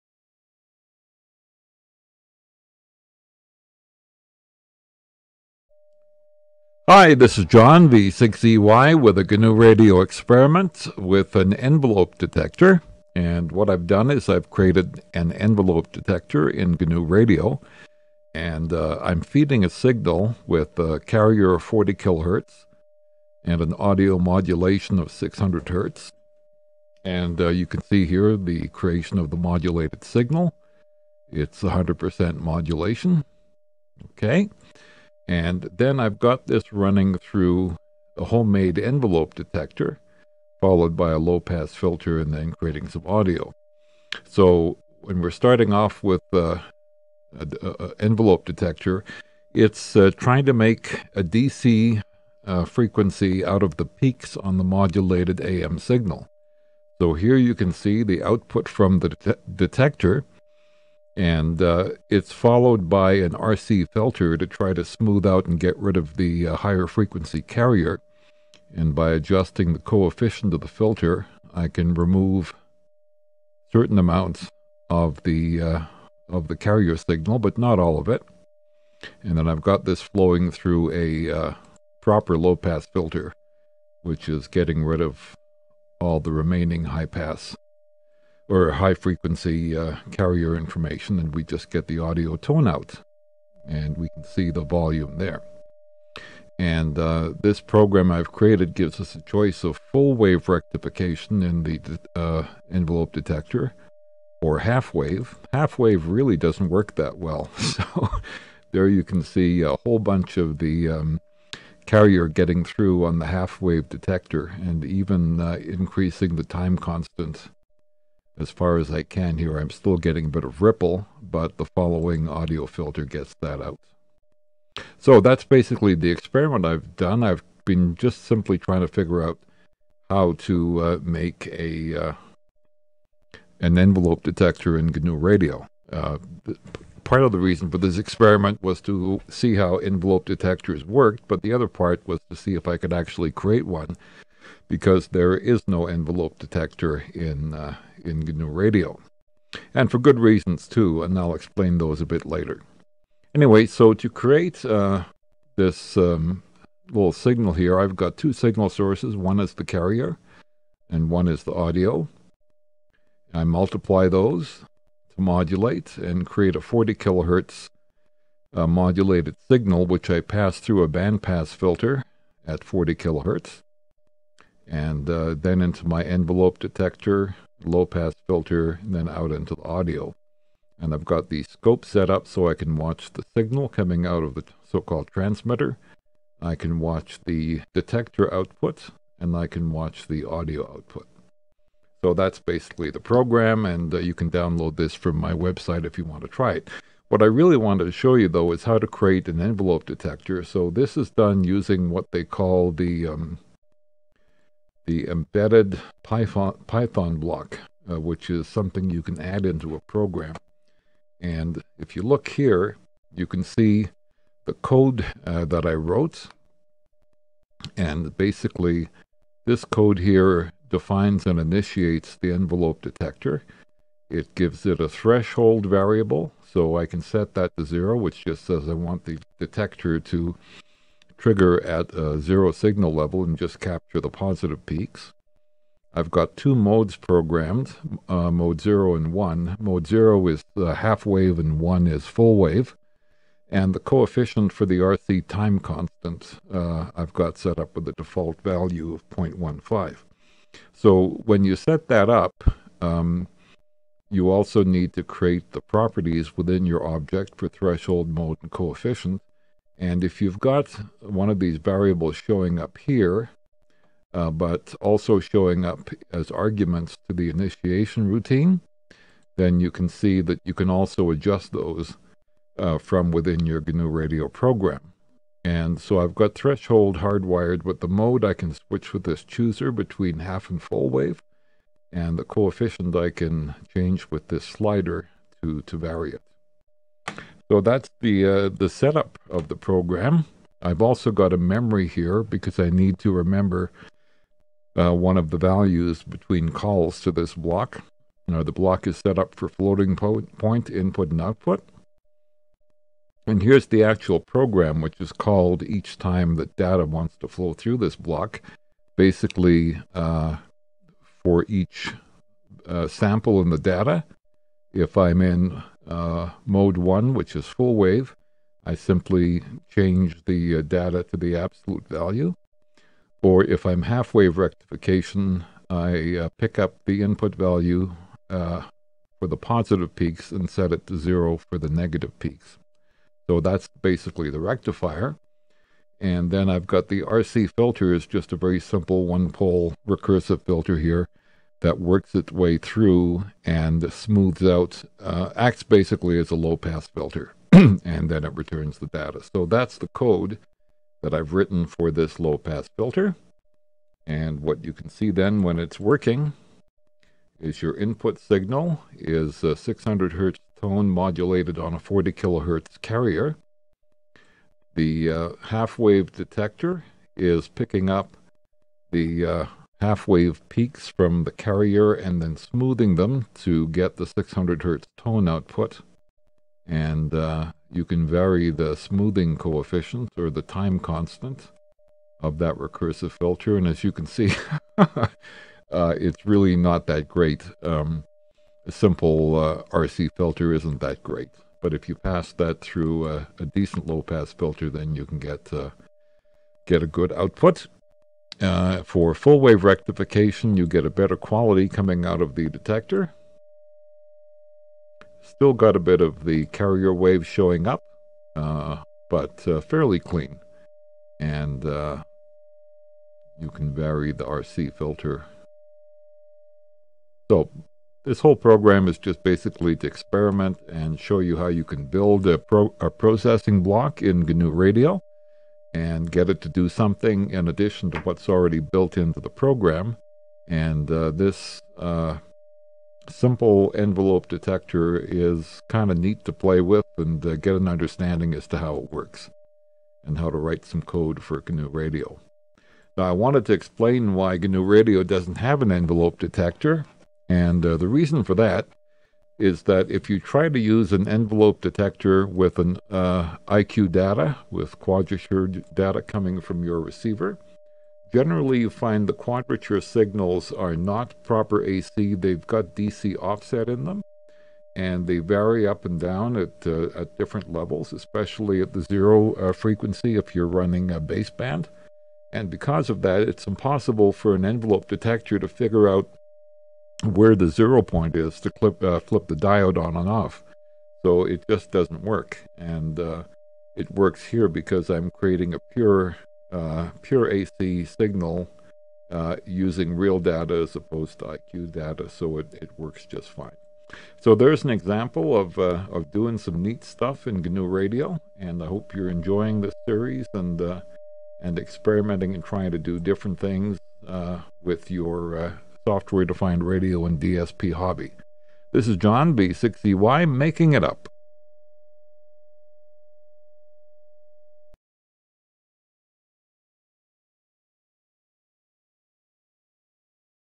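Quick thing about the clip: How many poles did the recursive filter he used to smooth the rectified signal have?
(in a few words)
One pole.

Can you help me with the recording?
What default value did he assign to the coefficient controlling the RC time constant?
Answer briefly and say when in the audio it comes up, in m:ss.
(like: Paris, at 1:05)
0.15, at 4:09.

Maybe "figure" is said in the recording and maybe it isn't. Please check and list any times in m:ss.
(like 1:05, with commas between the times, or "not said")
2:08, 7:55.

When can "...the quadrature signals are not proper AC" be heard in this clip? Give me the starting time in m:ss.
7:39.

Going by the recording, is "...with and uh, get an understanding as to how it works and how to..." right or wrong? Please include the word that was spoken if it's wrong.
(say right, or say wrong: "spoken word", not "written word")
right.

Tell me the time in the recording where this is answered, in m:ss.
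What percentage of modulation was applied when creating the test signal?
0:31.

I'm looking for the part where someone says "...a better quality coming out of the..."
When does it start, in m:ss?
6:40.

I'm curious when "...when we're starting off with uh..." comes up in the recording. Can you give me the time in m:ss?
0:44.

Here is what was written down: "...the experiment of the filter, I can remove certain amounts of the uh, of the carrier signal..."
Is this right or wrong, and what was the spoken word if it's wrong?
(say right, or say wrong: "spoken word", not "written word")
wrong: "coefficient", not "experiment".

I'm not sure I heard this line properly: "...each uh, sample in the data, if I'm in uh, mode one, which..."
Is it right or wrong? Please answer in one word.
right.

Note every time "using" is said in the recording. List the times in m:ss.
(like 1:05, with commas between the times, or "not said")
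3:21, 8:09.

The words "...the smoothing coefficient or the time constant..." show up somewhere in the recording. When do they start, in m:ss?
6:18.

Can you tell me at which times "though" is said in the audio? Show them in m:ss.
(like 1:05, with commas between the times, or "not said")
3:18.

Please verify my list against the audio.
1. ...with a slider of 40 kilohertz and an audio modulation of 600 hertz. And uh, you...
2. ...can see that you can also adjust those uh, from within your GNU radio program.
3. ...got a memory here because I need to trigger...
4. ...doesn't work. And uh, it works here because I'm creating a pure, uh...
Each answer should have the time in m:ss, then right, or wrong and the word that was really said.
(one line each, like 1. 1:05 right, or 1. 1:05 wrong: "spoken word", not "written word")
1. 0:20 wrong: "carrier", not "slider"
2. 4:29 right
3. 4:51 wrong: "remember", not "trigger"
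4. 8:01 right.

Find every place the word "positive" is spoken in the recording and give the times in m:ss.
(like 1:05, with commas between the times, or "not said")
3:54, 5:29.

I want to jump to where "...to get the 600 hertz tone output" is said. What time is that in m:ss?
6:13.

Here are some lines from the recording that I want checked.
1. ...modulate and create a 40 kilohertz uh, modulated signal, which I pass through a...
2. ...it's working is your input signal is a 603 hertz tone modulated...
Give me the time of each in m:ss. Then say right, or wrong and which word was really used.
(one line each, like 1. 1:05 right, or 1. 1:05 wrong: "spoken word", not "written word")
1. 2:45 right
2. 5:55 wrong: "600", not "603".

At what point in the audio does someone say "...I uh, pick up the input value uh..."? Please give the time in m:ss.
5:25.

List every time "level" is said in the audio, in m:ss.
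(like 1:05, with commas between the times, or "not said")
3:52, 7:47.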